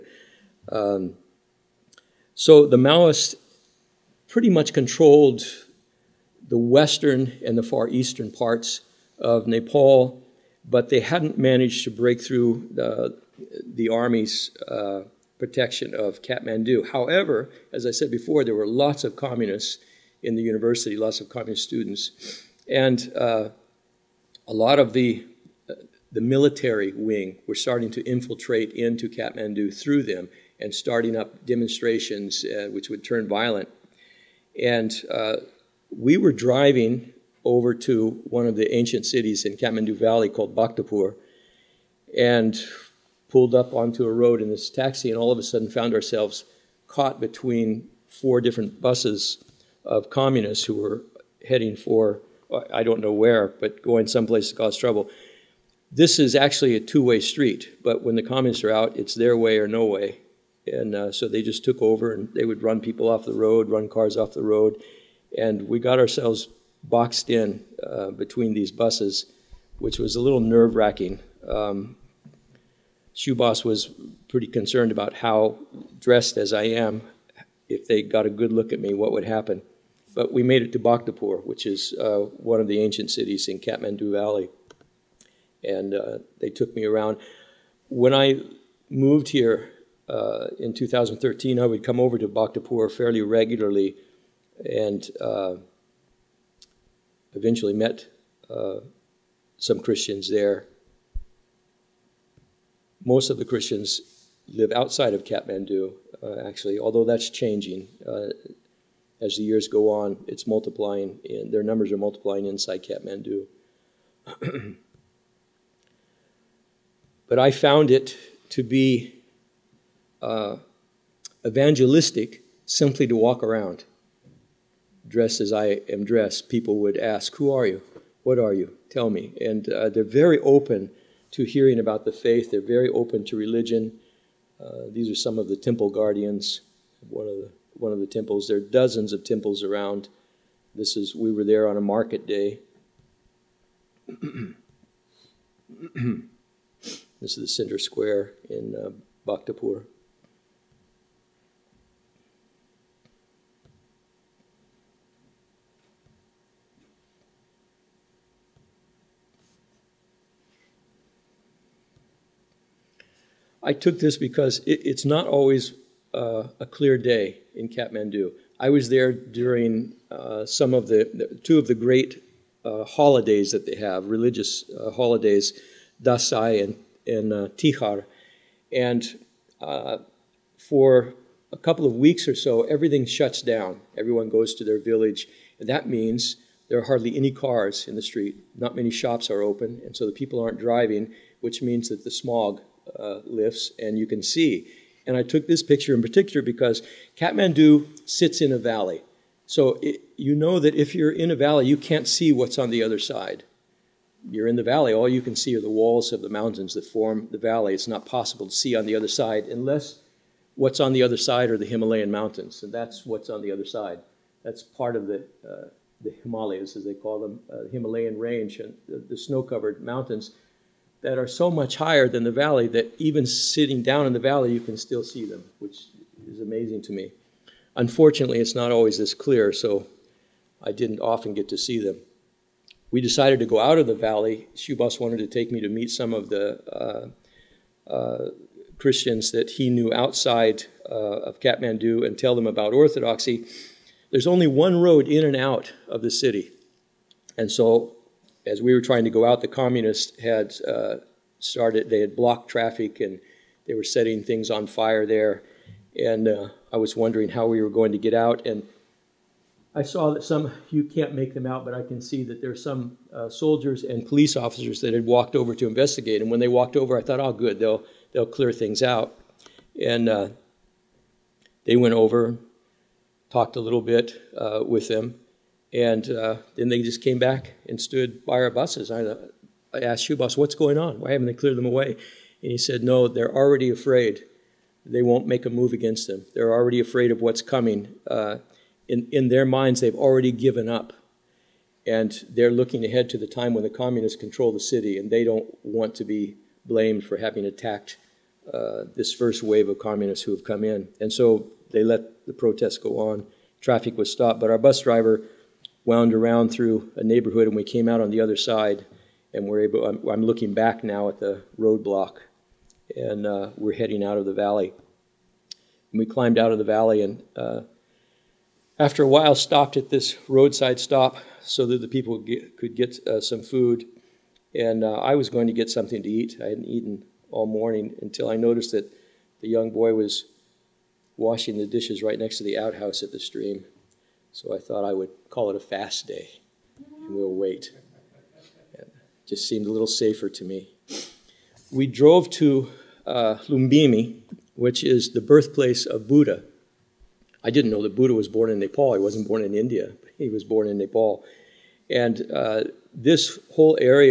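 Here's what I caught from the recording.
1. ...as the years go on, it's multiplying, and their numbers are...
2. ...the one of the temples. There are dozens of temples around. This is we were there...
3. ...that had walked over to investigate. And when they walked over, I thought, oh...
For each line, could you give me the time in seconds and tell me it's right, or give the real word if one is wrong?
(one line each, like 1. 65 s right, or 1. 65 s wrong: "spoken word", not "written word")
1. 109 s right
2. 137 s right
3. 264 s right.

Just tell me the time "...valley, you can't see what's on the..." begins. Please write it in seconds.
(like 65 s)
201 s.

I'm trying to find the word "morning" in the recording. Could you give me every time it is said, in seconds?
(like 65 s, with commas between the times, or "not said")
327 s.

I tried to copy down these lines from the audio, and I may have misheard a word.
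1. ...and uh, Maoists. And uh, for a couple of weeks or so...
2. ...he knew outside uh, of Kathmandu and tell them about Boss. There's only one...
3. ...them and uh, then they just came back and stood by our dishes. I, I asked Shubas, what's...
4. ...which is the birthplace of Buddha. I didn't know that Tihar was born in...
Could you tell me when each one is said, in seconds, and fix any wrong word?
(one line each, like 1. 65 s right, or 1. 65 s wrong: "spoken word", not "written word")
1. 177 s wrong: "Tihar", not "Maoists"
2. 239 s wrong: "Orthodoxy", not "Boss"
3. 274 s wrong: "buses", not "dishes"
4. 344 s wrong: "Buddha", not "Tihar".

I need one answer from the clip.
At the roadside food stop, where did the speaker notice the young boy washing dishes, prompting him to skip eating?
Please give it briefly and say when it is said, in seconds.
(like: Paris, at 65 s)
next to the outhouse, at 332 s.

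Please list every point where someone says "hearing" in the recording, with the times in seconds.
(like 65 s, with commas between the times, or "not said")
131 s.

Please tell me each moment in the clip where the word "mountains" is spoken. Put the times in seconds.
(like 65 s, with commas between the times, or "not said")
206 s, 212 s, 219 s.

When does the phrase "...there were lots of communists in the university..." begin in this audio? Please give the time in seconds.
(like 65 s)
18 s.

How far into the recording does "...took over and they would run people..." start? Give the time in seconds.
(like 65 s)
61 s.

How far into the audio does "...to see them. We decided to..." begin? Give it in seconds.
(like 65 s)
231 s.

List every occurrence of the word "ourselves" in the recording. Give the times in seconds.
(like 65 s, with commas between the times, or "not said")
45 s, 65 s.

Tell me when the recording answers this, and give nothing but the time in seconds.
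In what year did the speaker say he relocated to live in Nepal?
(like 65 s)
90 s.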